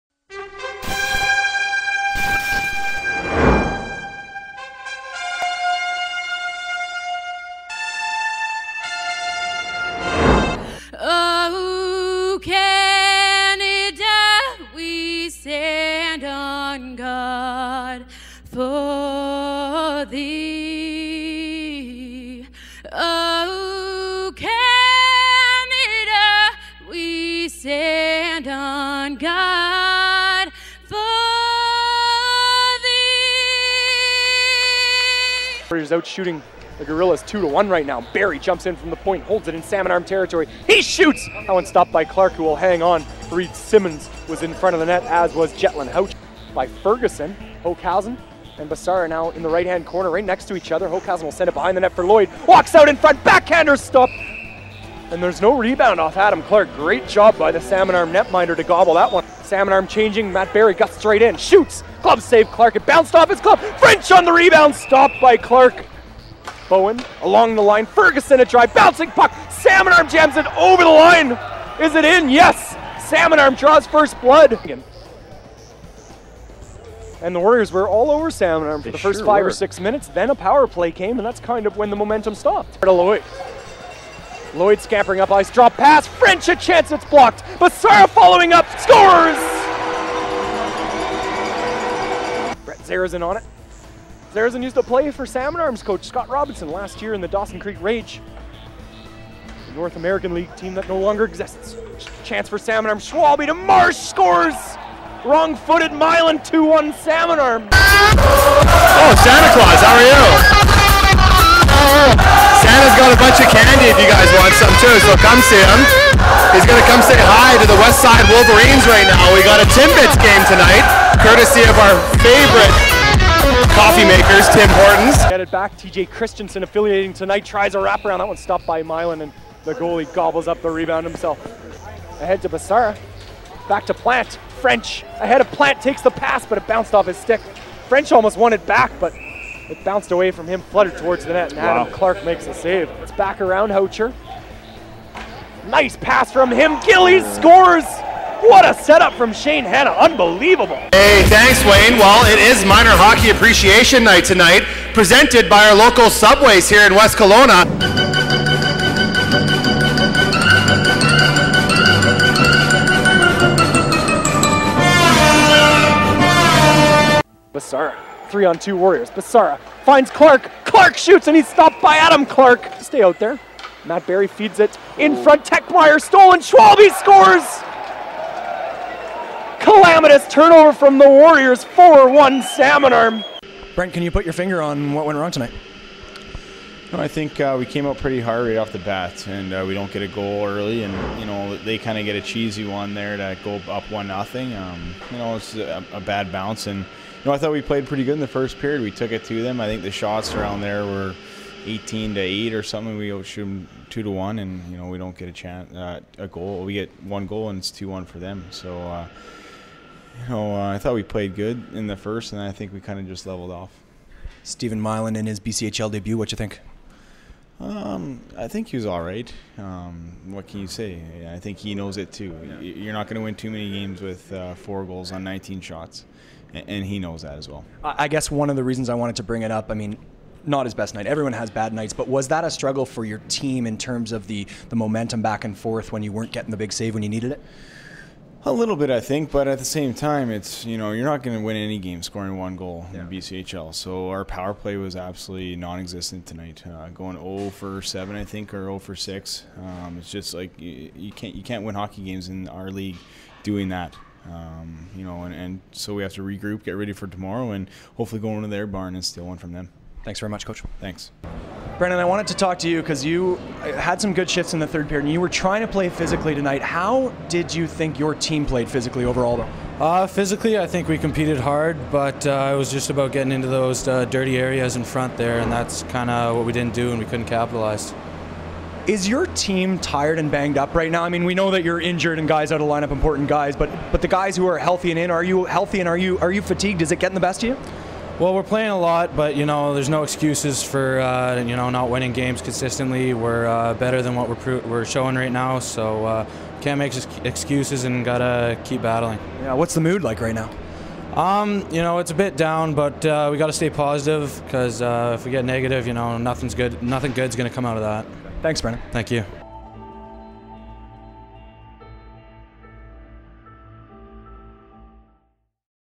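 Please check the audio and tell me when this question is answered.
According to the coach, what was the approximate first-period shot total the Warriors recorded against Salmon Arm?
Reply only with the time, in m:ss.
3:21.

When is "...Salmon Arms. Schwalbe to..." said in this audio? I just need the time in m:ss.
1:42.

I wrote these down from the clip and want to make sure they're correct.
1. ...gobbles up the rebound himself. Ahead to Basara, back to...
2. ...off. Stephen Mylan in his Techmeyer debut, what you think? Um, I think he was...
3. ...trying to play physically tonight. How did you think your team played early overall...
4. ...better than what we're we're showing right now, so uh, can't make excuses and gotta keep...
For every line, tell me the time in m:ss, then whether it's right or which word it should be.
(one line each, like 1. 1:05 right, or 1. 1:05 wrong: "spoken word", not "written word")
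1. 2:10 right
2. 3:33 wrong: "BCHL", not "Techmeyer"
3. 4:25 wrong: "physically", not "early"
4. 4:53 right.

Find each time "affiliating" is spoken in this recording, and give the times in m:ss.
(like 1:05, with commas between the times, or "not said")
2:06.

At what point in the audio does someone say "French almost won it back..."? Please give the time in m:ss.
2:17.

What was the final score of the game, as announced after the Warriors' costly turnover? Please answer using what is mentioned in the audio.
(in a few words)
4-1 Salmon Arm.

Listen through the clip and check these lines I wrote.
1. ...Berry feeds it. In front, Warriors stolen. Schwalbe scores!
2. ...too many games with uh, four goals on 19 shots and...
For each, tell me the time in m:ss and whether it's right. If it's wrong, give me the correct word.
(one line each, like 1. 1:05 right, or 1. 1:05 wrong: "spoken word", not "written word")
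1. 2:54 wrong: "Techmeyer", not "Warriors"
2. 3:43 right.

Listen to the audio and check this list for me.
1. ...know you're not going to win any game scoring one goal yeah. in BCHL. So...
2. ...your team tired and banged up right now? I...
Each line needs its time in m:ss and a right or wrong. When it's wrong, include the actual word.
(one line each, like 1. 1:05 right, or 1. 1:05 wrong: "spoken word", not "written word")
1. 4:00 right
2. 4:39 right.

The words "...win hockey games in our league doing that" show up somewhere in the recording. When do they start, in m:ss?
4:11.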